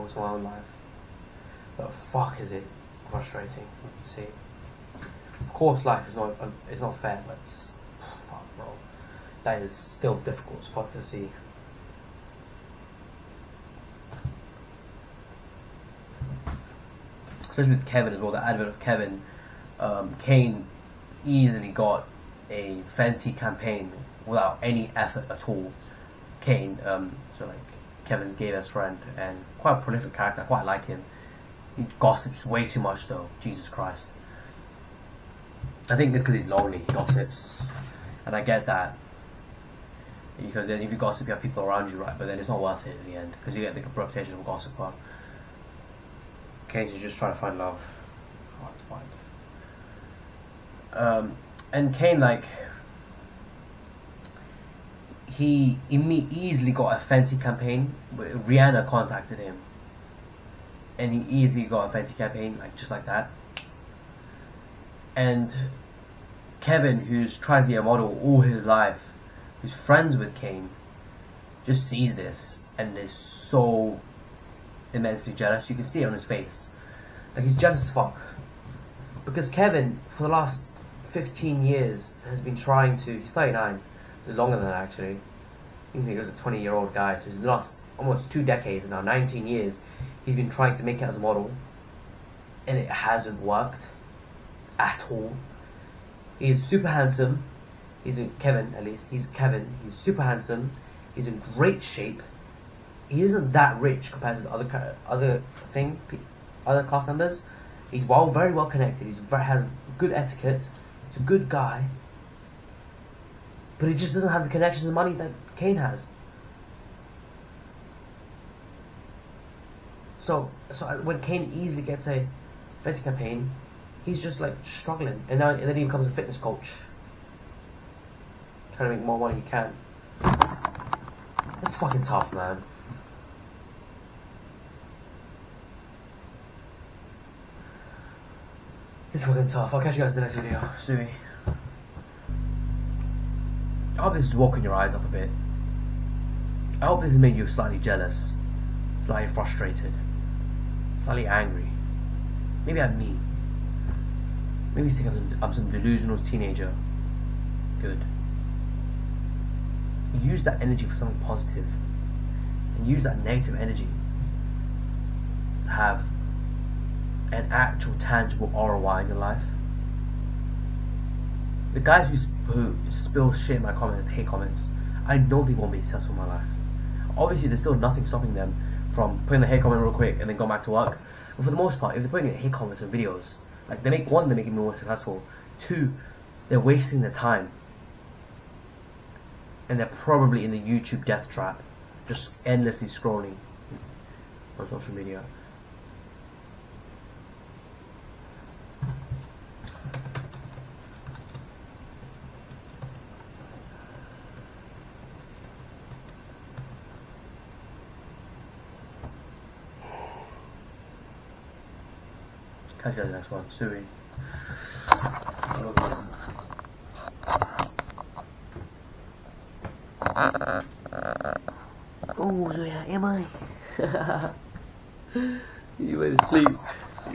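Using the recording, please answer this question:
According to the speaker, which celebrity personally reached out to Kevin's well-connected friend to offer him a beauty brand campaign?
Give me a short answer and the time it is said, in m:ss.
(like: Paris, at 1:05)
Rihanna, at 0:58.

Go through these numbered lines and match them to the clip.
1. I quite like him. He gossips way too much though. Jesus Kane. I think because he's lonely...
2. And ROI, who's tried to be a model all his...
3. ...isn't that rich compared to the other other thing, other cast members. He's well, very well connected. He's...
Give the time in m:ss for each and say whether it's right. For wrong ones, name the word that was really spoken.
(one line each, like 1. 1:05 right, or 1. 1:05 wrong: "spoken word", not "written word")
1. 0:30 wrong: "Christ", not "Kane"
2. 1:05 wrong: "Kevin", not "ROI"
3. 1:43 right.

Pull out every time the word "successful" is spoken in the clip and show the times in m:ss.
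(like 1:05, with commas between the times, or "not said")
2:55, 3:04.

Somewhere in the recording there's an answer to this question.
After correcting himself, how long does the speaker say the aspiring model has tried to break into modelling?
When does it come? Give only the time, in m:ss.
1:29.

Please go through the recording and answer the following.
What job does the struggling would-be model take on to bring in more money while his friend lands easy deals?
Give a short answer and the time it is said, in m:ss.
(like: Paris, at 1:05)
Fitness coach, at 2:06.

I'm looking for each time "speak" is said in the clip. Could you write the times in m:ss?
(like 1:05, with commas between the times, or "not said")
not said.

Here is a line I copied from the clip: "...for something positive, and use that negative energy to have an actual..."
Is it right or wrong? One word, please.
right.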